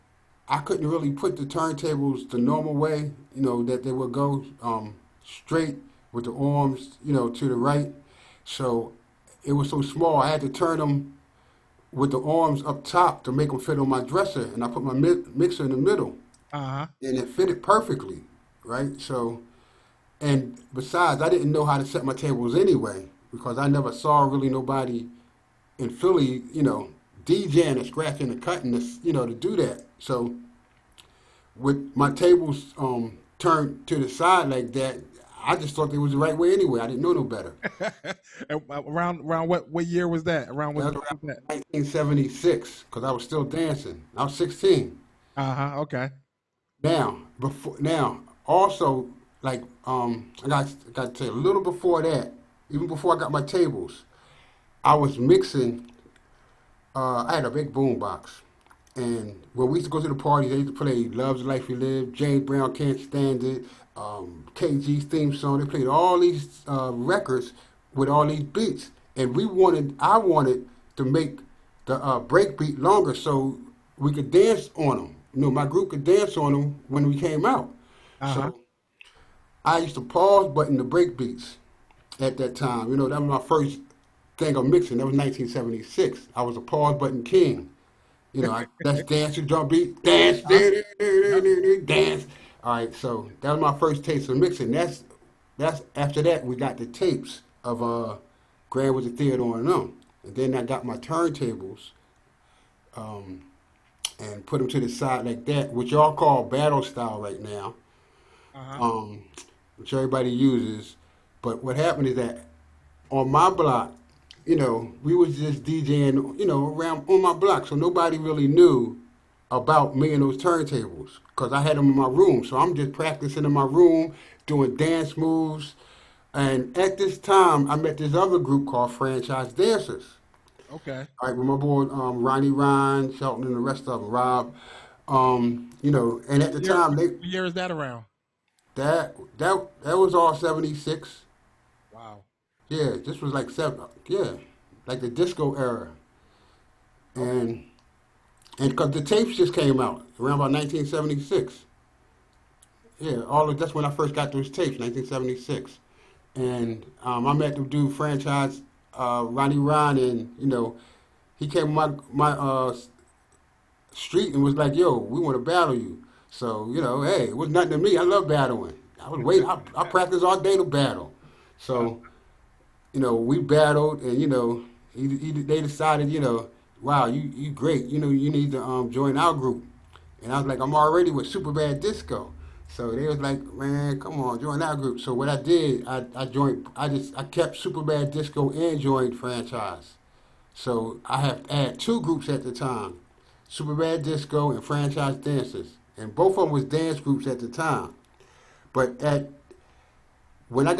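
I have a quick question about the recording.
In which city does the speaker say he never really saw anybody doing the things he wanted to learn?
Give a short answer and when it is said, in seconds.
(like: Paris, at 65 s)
Philly, at 25 s.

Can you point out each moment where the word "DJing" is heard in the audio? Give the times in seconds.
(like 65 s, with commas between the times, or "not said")
27 s, 115 s.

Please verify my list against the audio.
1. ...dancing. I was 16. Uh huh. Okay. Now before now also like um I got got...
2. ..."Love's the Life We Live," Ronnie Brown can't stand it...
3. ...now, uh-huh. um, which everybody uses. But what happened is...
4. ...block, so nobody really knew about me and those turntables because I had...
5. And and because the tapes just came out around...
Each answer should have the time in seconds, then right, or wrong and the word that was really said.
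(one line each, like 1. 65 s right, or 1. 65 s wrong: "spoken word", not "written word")
1. 43 s right
2. 61 s wrong: "James", not "Ronnie"
3. 107 s right
4. 117 s right
5. 147 s right.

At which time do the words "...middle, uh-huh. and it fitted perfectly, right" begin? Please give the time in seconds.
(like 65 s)
15 s.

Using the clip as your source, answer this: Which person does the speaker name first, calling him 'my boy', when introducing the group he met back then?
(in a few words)
Ronnie Ryan.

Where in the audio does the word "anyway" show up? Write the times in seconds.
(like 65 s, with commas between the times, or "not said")
22 s, 36 s.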